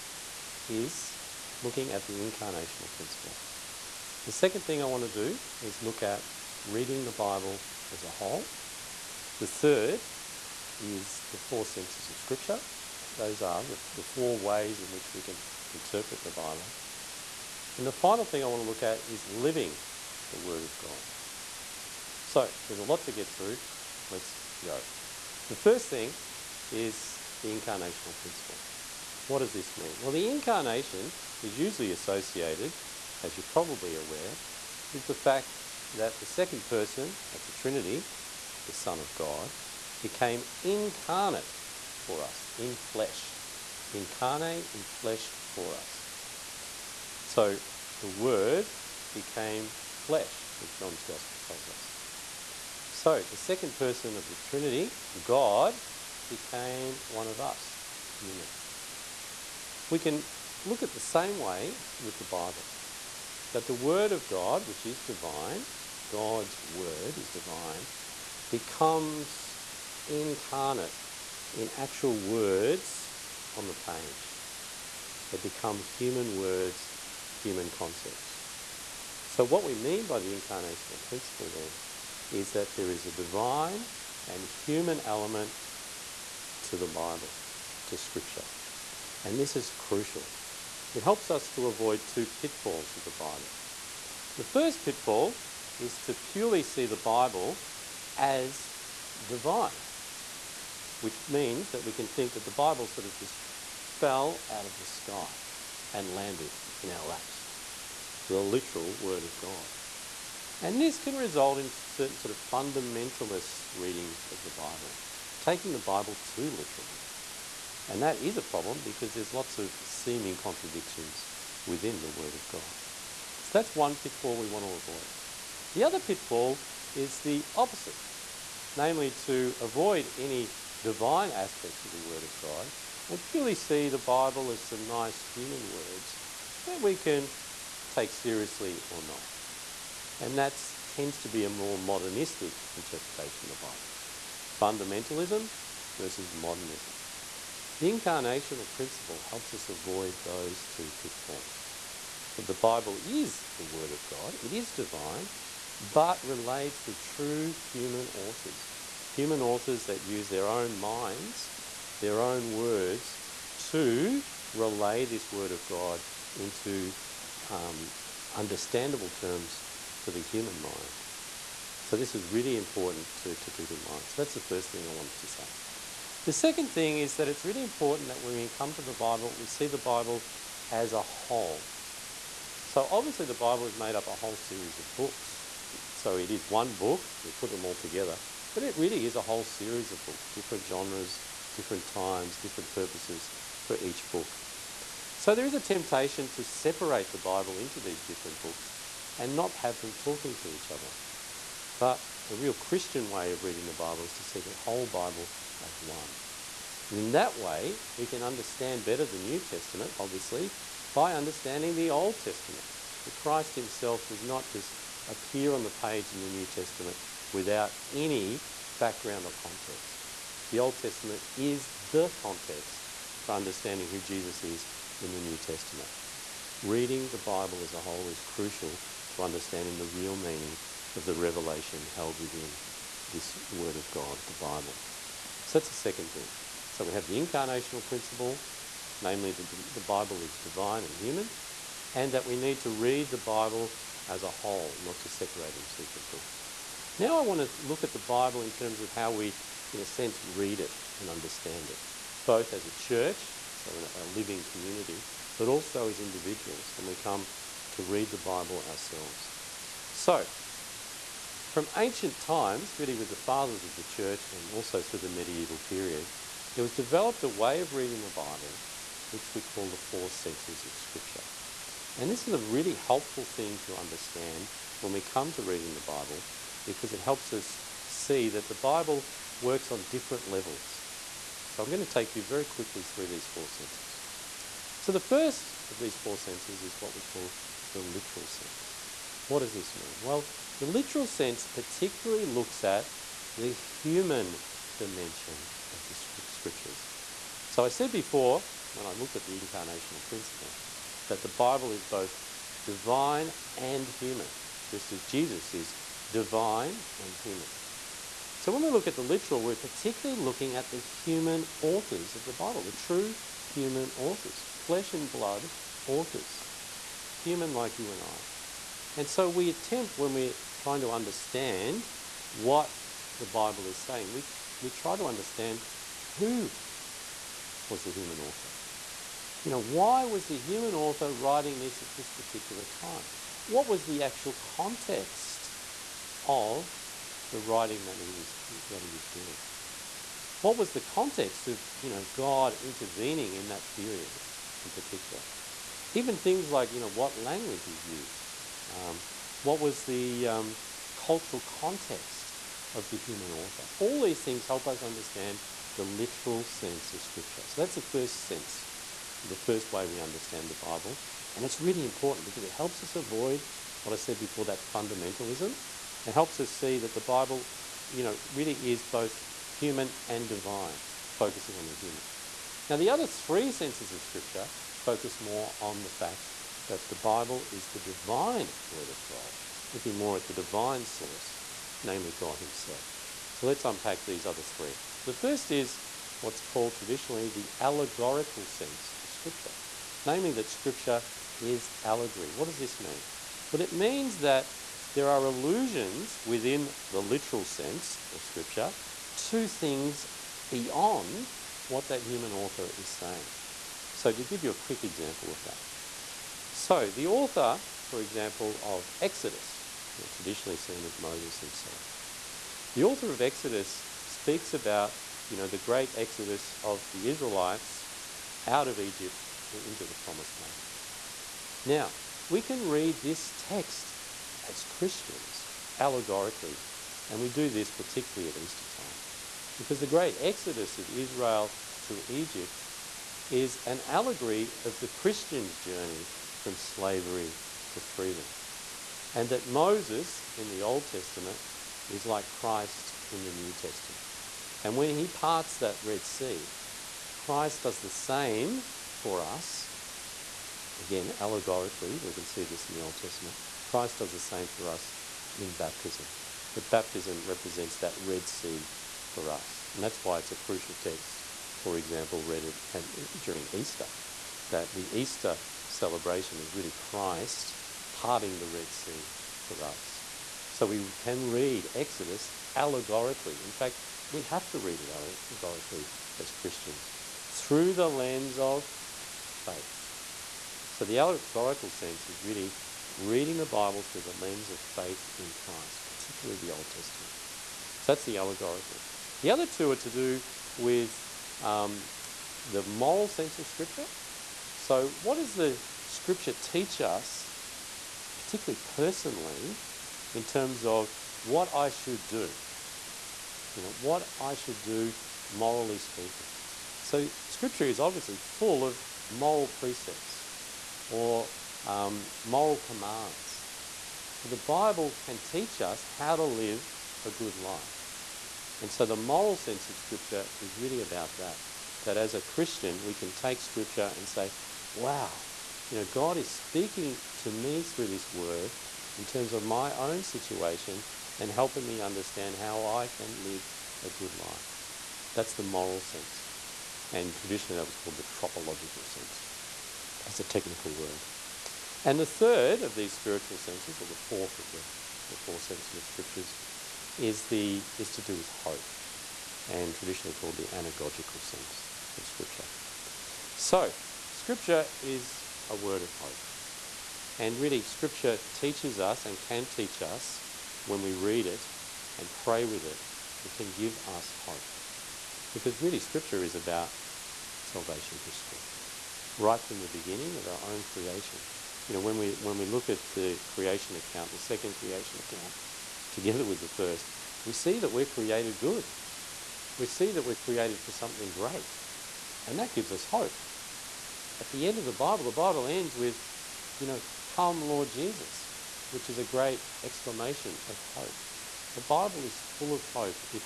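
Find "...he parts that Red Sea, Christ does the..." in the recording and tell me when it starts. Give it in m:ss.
7:24.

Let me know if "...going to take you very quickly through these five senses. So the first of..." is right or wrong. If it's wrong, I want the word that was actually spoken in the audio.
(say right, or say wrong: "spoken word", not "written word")
wrong: "four", not "five".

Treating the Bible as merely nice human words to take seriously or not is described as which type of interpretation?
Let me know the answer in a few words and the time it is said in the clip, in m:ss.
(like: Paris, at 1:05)
modernistic, at 2:21.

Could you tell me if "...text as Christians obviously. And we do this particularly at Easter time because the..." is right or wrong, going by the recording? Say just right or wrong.
wrong.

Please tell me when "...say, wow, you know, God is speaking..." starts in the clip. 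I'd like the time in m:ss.
8:44.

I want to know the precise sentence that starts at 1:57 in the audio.
And that is a problem because there's lots of seeming contradictions within the Word of God.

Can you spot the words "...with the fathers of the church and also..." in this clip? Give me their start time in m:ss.
4:22.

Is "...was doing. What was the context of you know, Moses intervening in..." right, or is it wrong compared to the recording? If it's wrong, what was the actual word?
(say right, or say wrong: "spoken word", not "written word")
wrong: "God", not "Moses".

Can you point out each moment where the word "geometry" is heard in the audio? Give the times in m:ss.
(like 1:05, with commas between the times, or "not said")
not said.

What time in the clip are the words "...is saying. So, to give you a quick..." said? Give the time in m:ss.
6:42.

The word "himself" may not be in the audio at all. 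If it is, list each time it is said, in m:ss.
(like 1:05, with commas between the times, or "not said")
3:33, 6:22, 6:51.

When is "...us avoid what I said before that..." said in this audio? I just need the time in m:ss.
6:02.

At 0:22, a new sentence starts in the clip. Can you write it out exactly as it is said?
So there's a lot to get through.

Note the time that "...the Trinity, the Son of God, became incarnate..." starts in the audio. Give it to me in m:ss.
0:37.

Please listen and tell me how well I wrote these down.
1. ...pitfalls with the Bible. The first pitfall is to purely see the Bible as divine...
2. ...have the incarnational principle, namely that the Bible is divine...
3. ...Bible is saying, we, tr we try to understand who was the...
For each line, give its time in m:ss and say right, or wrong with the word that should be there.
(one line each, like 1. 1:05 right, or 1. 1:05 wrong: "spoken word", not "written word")
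1. 1:32 right
2. 3:56 right
3. 5:23 right.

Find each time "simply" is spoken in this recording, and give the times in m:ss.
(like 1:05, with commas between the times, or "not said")
not said.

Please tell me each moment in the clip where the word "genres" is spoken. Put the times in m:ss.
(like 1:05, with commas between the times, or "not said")
3:10.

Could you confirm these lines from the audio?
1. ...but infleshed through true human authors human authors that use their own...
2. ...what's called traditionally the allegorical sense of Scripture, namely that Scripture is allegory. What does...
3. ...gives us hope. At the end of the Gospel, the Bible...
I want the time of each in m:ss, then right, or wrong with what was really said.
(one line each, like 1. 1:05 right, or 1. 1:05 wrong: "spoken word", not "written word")
1. 2:35 wrong: "relayed", not "infleshed"
2. 6:26 right
3. 9:42 wrong: "Bible", not "Gospel".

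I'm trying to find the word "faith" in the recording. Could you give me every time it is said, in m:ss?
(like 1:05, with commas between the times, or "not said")
7:59, 8:04.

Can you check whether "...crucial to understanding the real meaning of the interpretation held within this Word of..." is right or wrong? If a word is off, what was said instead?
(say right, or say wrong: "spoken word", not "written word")
wrong: "revelation", not "interpretation".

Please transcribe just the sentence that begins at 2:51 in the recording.
So, this is really important to, to keep in mind.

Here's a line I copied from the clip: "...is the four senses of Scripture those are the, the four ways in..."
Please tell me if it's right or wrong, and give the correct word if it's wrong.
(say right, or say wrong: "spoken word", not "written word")
right.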